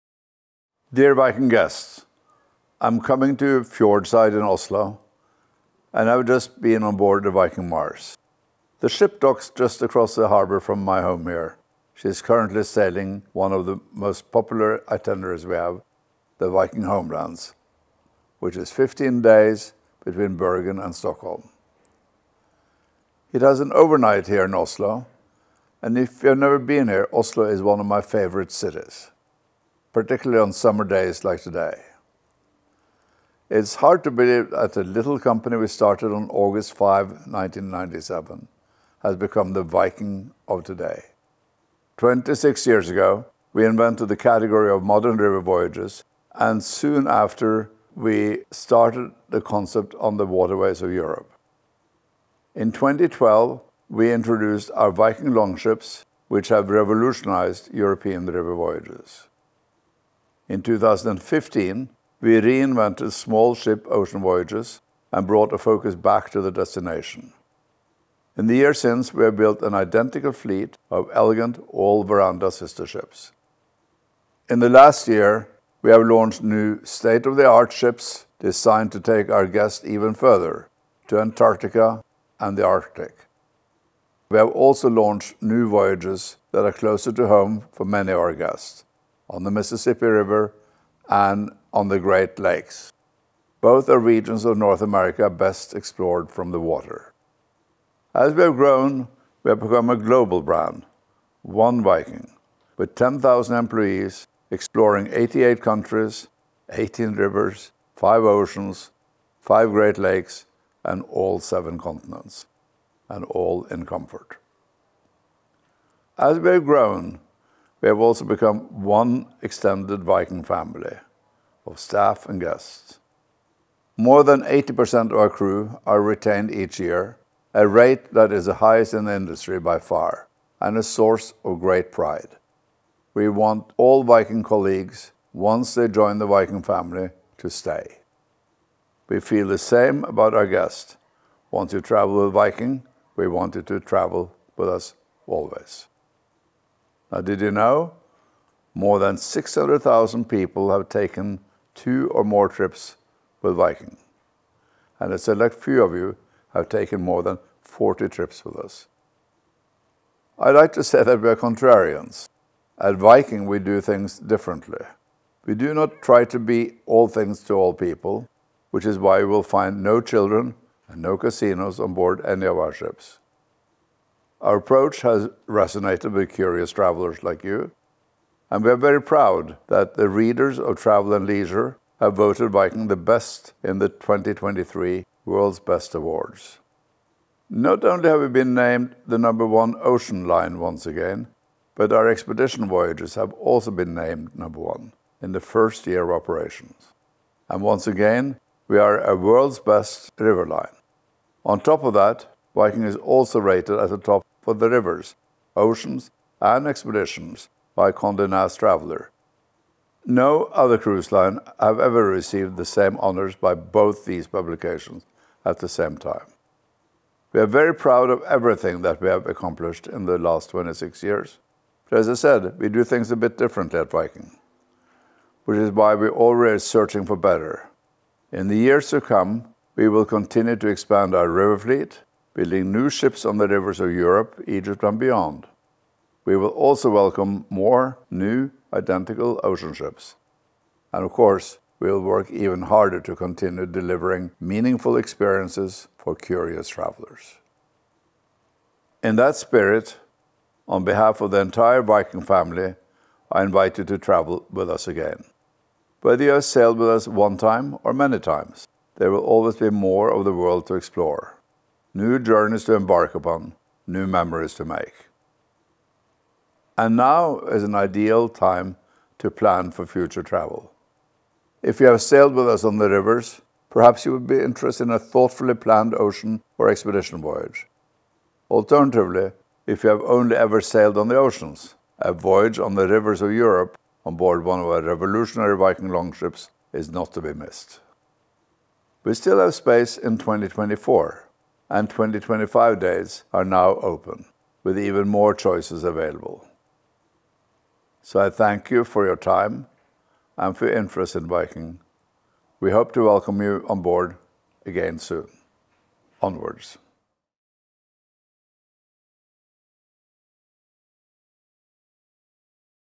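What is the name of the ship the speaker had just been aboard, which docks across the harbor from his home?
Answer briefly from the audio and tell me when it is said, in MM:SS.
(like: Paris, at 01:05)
Viking Mars, at 00:07.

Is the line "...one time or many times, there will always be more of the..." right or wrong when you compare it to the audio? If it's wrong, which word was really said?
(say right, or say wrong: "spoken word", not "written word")
right.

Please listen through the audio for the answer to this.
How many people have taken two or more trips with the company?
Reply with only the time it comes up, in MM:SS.
02:29.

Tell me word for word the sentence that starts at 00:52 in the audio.
In 2012, we introduced our Viking longships, which have revolutionized European river voyages.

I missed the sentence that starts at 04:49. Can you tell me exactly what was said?
We still have space in 2024 and 2025 dates are now open, with even more choices available.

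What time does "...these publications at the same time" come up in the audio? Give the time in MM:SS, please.
03:34.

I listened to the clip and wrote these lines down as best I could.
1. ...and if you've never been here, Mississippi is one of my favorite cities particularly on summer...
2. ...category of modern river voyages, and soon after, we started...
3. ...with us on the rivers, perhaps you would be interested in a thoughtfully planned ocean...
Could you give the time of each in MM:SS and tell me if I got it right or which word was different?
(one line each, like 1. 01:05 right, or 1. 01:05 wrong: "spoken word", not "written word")
1. 00:25 wrong: "Oslo", not "Mississippi"
2. 00:44 right
3. 04:32 right.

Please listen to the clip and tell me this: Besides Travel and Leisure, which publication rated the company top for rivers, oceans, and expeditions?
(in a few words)
Condé Nast Traveller.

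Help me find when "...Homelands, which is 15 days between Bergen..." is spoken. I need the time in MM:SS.
00:16.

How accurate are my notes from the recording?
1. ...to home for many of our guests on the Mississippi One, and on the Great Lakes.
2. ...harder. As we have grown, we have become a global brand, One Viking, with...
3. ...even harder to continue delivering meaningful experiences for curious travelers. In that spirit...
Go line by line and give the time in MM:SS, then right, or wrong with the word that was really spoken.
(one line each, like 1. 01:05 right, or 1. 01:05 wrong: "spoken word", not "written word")
1. 01:27 wrong: "River", not "One"
2. 01:36 wrong: "water", not "harder"
3. 04:02 right.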